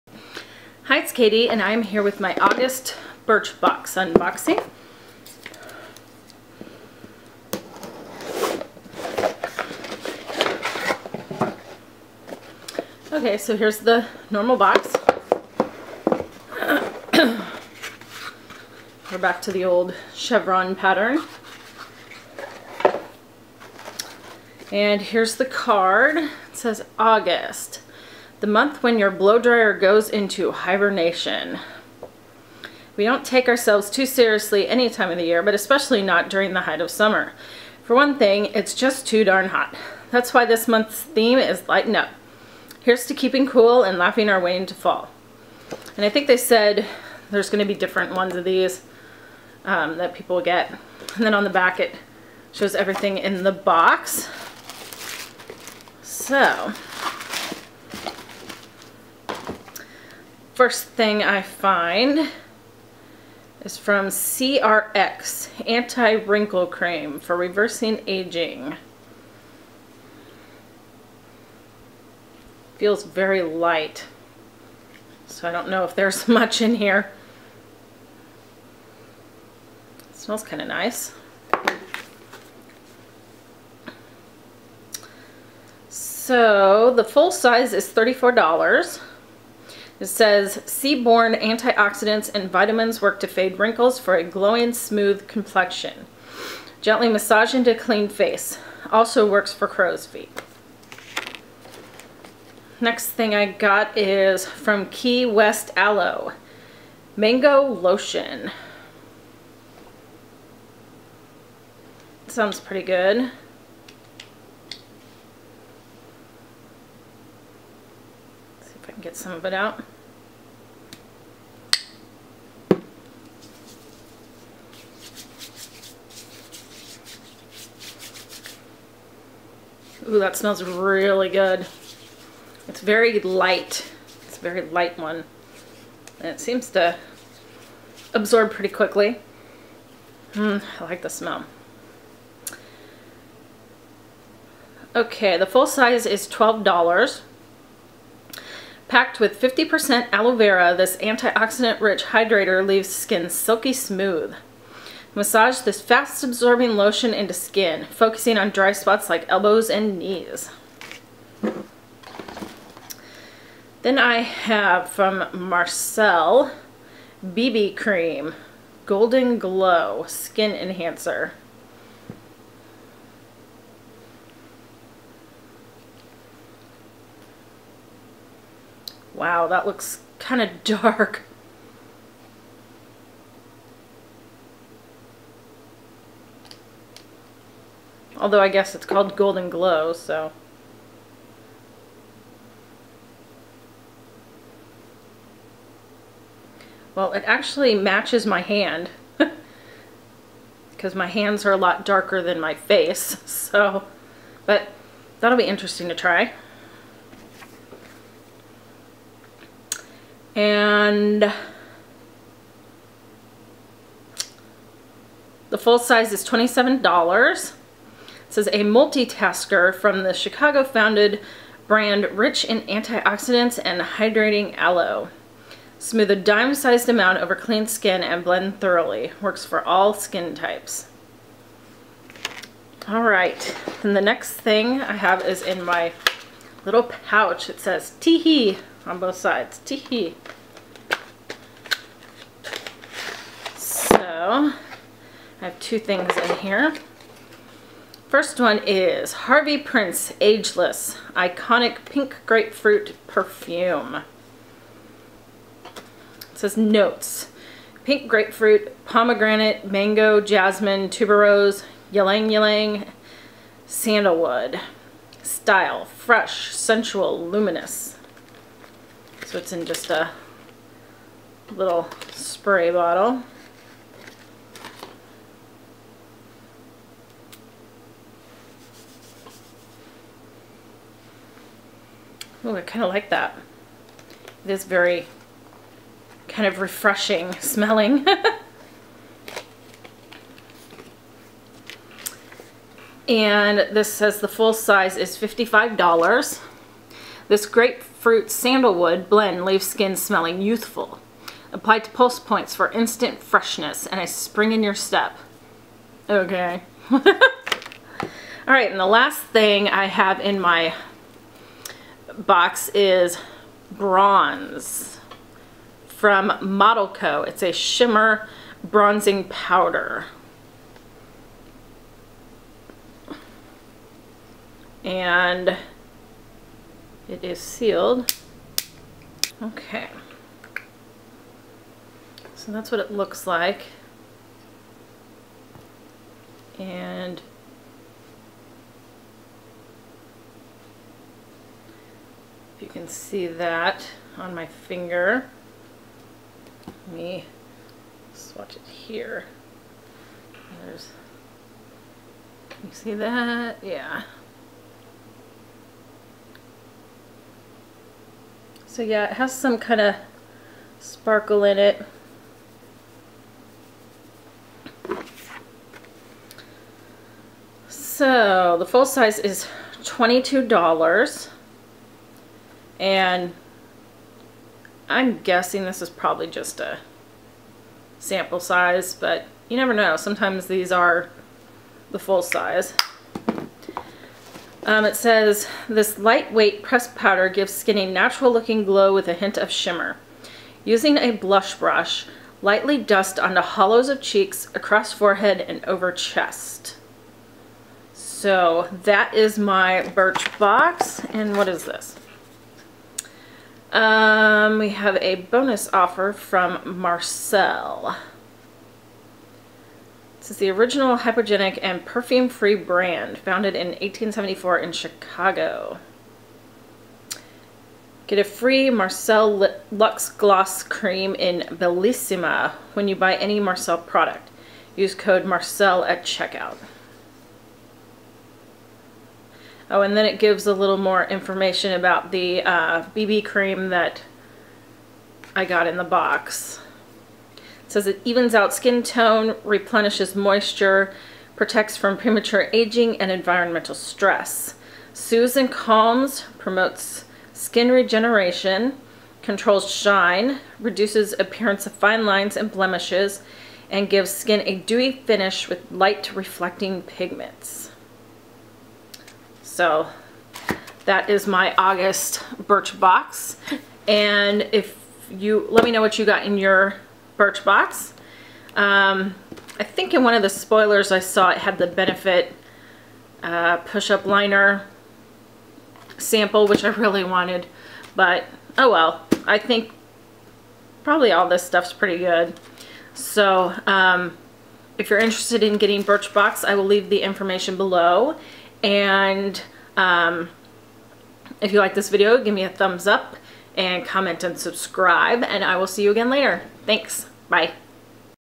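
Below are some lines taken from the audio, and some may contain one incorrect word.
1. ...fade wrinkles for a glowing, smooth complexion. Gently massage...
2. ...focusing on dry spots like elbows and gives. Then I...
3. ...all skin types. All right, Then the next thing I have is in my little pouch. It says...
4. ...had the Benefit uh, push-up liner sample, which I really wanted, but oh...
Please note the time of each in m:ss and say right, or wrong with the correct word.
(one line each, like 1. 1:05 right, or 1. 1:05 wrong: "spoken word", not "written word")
1. 1:33 right
2. 2:37 wrong: "knees", not "gives"
3. 3:49 right
4. 7:51 right.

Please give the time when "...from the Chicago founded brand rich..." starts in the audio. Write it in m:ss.
3:39.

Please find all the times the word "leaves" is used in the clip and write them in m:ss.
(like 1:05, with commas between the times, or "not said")
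2:32, 4:59, 8:06.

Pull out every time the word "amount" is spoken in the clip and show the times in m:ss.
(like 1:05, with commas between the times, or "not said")
3:46.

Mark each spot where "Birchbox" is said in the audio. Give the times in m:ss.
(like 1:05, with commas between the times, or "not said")
0:03, 6:39, 7:42, 7:47, 8:05.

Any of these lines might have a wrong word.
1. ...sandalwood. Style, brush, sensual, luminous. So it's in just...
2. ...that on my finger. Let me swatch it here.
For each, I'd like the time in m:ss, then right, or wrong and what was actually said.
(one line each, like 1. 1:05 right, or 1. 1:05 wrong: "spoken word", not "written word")
1. 4:23 wrong: "fresh", not "brush"
2. 5:43 right.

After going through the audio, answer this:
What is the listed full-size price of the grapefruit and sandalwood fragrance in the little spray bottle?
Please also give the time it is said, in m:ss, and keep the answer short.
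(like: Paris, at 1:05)
$55, at 4:55.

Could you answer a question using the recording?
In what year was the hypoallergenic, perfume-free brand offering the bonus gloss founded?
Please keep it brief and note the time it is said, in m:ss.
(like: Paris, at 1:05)
1874, at 6:53.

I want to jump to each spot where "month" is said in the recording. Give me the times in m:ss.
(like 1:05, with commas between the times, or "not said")
0:28, 0:40.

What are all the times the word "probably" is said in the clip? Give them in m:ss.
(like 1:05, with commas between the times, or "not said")
6:15, 8:00.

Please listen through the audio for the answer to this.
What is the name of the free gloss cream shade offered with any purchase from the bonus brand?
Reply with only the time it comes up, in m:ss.
7:01.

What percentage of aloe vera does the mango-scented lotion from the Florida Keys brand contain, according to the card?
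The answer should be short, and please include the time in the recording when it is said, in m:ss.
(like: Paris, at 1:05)
50%, at 2:29.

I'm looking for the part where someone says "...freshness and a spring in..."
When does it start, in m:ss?
5:03.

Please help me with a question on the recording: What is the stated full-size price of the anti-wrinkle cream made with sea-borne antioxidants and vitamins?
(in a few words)
$34.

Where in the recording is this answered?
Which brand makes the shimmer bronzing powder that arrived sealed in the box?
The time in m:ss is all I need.
5:16.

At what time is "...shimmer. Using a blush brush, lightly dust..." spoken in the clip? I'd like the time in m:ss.
6:29.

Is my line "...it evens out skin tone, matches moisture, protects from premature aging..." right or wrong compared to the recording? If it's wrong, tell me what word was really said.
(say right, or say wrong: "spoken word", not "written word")
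wrong: "replenishes", not "matches".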